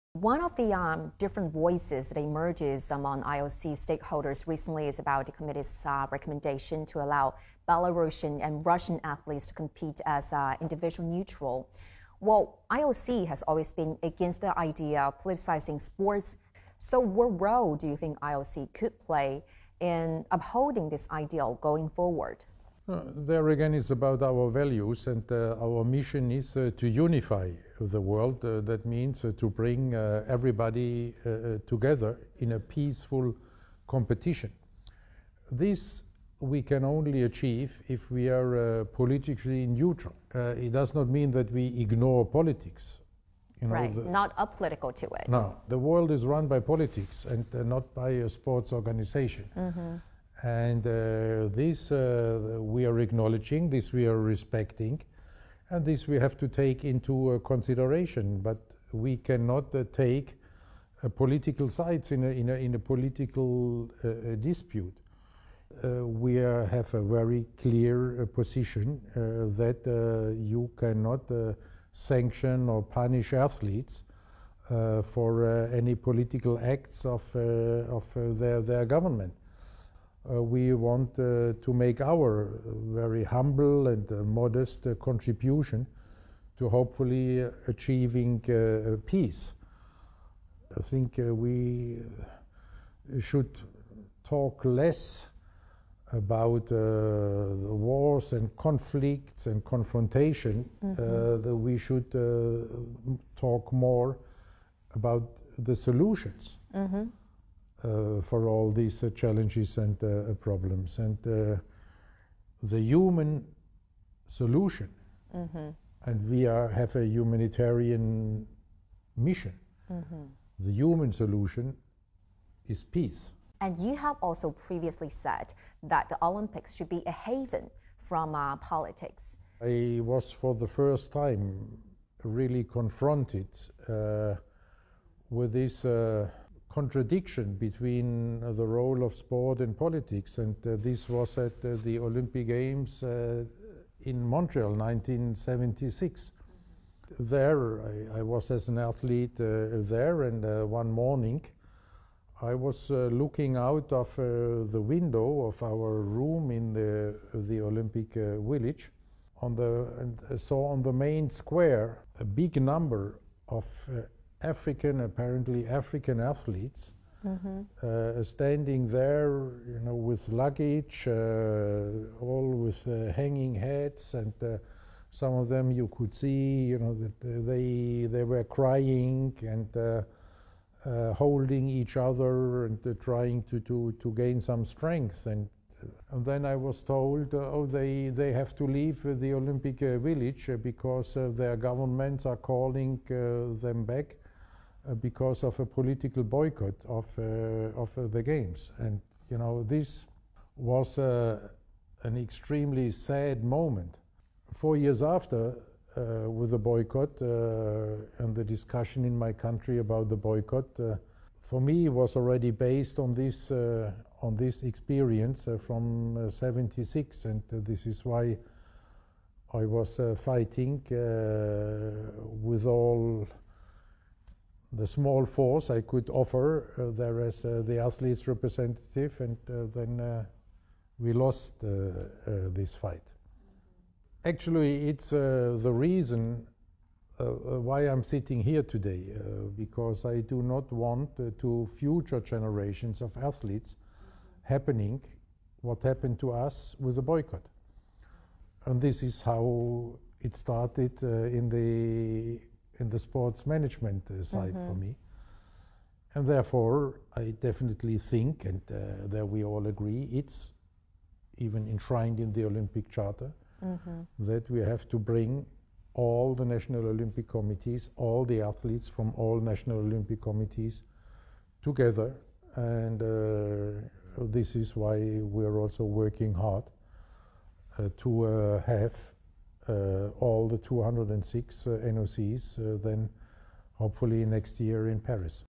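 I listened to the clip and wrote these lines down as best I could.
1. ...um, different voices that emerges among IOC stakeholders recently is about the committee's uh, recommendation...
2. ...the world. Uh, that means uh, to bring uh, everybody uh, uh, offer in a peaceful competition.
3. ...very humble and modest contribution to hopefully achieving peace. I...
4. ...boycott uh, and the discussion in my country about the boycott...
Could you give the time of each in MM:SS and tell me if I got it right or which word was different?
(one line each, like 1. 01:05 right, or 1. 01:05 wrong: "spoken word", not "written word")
1. 00:00 right
2. 00:27 wrong: "together", not "offer"
3. 01:22 right
4. 03:26 right.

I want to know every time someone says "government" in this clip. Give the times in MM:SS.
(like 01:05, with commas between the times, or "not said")
01:18, 03:11.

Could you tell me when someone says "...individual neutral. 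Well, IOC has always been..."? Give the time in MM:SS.
00:10.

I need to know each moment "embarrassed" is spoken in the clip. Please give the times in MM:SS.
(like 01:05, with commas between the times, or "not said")
not said.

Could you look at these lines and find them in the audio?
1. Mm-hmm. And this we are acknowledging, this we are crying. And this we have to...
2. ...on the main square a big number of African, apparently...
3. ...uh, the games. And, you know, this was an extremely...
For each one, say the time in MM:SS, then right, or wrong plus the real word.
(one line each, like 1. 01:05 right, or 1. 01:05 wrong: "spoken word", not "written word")
1. 00:49 wrong: "respecting", not "crying"
2. 02:40 right
3. 03:17 right.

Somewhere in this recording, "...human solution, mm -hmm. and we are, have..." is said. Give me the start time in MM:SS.
01:52.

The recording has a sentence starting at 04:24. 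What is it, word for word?
that we have to bring all the National Olympic Committees, all the athletes from all National Olympic Committees together.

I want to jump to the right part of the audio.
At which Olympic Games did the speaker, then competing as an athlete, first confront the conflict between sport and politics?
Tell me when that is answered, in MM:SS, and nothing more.
02:24.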